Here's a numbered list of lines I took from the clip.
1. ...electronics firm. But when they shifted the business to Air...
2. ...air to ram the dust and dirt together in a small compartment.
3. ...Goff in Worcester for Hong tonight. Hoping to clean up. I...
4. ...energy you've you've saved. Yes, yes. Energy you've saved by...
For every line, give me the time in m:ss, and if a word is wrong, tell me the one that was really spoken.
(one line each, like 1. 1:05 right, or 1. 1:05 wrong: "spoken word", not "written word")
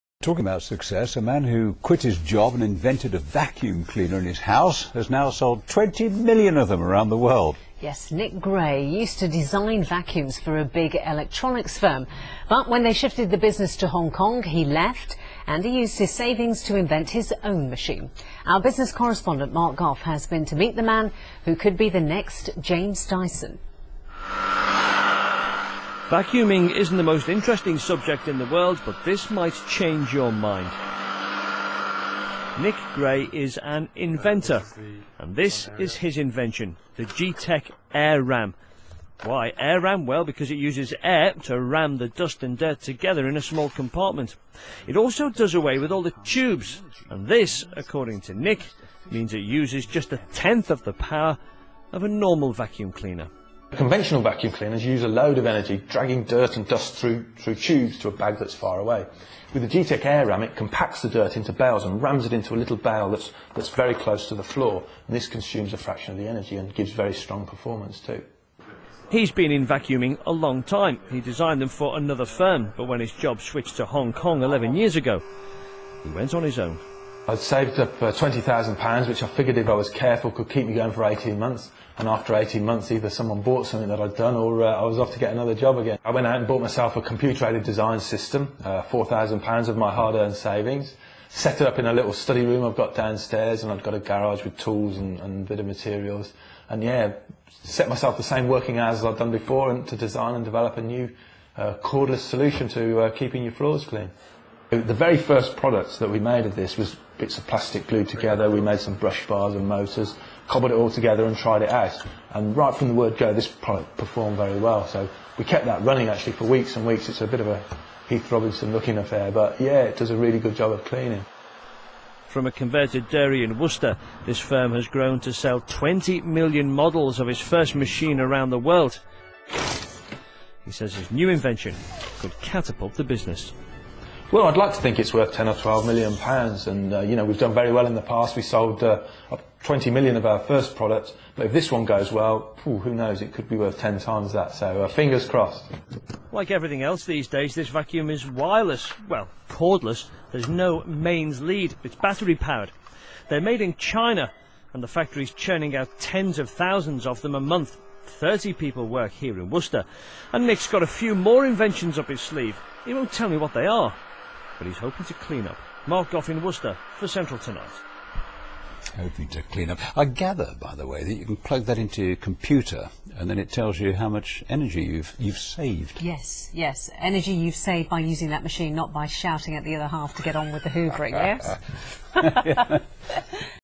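1. 0:11 wrong: "Hong", not "Air"
2. 0:41 right
3. 2:46 wrong: "Central", not "Hong"
4. 2:54 right.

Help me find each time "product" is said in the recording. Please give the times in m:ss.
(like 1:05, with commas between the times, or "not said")
1:45, 1:53, 2:20.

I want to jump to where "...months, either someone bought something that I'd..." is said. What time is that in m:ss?
1:22.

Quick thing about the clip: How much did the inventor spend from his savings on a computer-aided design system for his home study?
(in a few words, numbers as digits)
£4,000.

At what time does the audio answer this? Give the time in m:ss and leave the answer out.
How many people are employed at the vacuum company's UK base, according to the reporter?
2:38.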